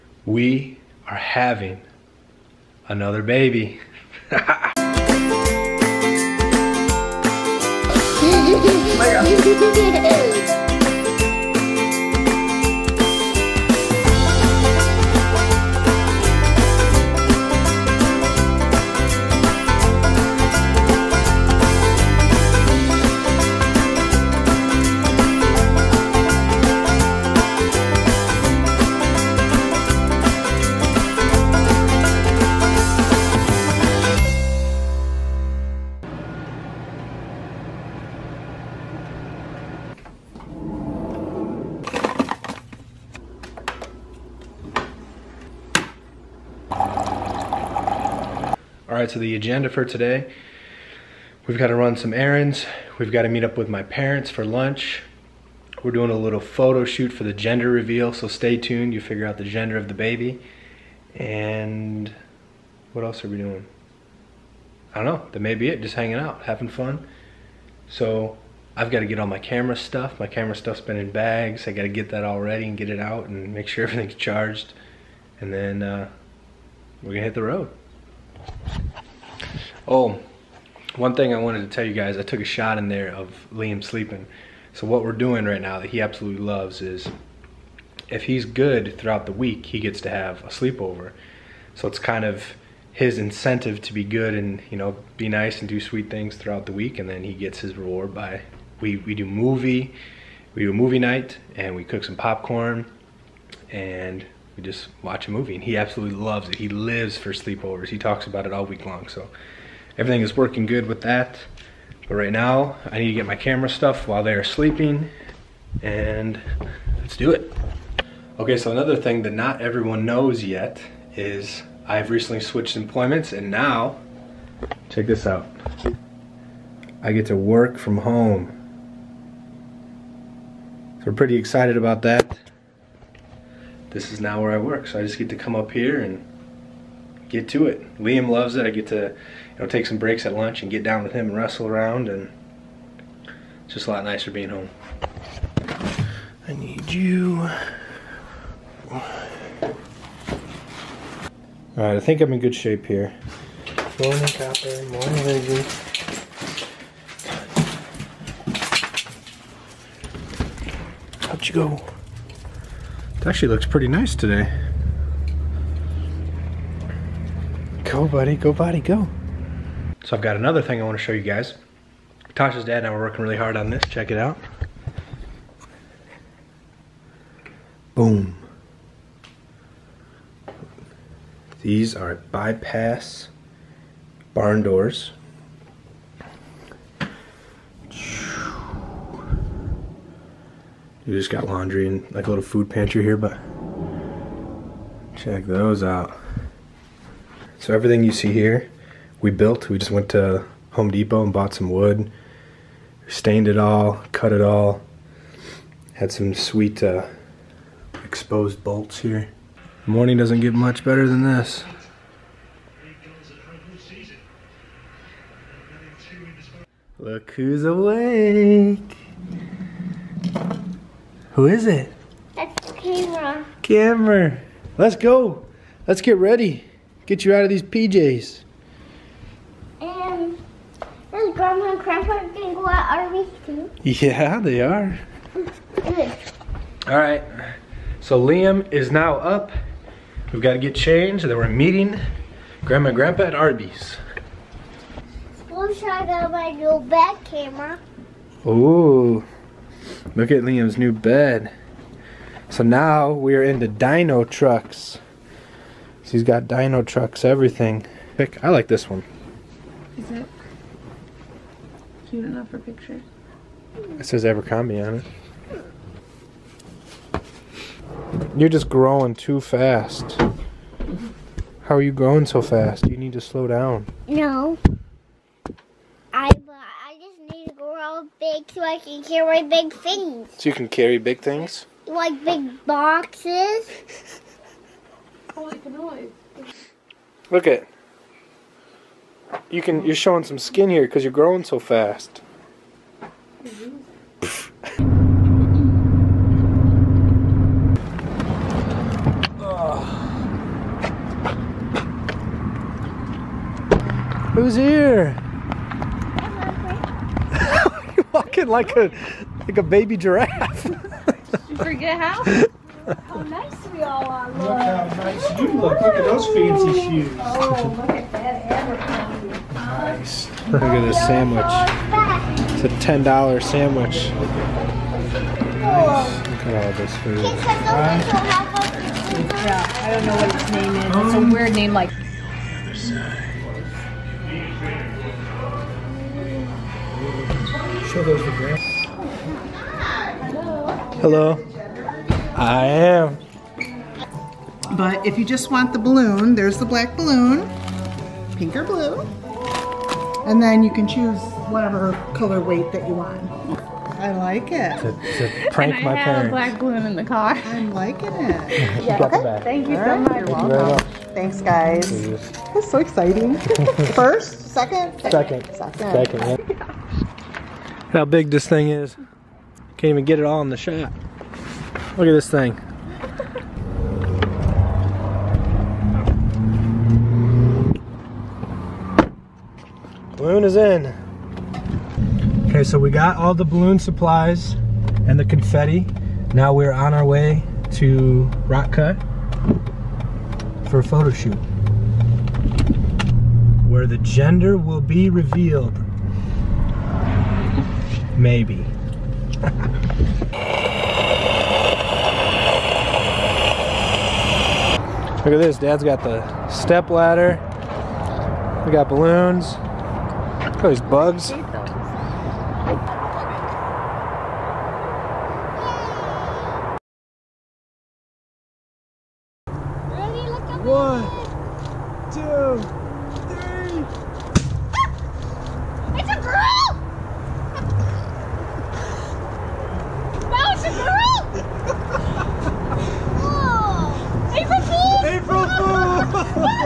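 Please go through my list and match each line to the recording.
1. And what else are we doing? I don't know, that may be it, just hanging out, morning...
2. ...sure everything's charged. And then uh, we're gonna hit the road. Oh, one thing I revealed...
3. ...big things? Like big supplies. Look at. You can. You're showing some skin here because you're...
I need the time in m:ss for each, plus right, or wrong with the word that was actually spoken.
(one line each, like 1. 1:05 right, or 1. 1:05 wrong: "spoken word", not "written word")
1. 1:01 wrong: "having", not "morning"
2. 1:13 wrong: "wanted", not "revealed"
3. 4:40 wrong: "boxes", not "supplies".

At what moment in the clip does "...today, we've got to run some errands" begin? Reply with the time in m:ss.
0:49.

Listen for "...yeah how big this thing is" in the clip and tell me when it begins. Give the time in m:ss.
6:06.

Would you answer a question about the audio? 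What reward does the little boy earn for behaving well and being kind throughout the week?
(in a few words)
A sleepover.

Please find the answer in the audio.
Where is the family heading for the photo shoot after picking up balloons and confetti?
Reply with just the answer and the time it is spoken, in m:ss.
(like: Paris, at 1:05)
Rock Cut, at 6:28.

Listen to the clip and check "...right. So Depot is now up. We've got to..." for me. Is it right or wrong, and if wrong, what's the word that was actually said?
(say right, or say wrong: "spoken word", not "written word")
wrong: "Liam", not "Depot".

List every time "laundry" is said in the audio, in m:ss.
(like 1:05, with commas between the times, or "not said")
3:11.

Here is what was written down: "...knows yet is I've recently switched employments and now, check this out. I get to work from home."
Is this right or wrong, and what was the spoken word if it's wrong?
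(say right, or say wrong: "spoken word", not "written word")
right.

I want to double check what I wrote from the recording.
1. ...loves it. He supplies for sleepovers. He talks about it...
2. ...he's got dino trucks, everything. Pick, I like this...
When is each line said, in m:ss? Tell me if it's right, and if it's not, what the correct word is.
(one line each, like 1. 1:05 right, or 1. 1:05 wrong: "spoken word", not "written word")
1. 1:46 wrong: "lives", not "supplies"
2. 4:16 right.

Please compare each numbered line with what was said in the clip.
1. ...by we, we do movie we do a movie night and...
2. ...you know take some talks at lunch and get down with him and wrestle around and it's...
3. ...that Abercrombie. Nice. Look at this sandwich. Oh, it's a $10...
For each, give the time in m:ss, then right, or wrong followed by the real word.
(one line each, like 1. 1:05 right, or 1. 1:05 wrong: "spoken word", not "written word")
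1. 1:38 right
2. 2:19 wrong: "breaks", not "talks"
3. 5:18 right.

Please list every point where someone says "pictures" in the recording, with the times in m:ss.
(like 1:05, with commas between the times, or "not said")
4:22.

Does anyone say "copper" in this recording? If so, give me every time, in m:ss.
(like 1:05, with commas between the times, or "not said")
2:34.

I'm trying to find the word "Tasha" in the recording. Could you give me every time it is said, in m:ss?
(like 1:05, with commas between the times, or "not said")
2:52.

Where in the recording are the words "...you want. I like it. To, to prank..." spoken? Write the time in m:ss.
5:52.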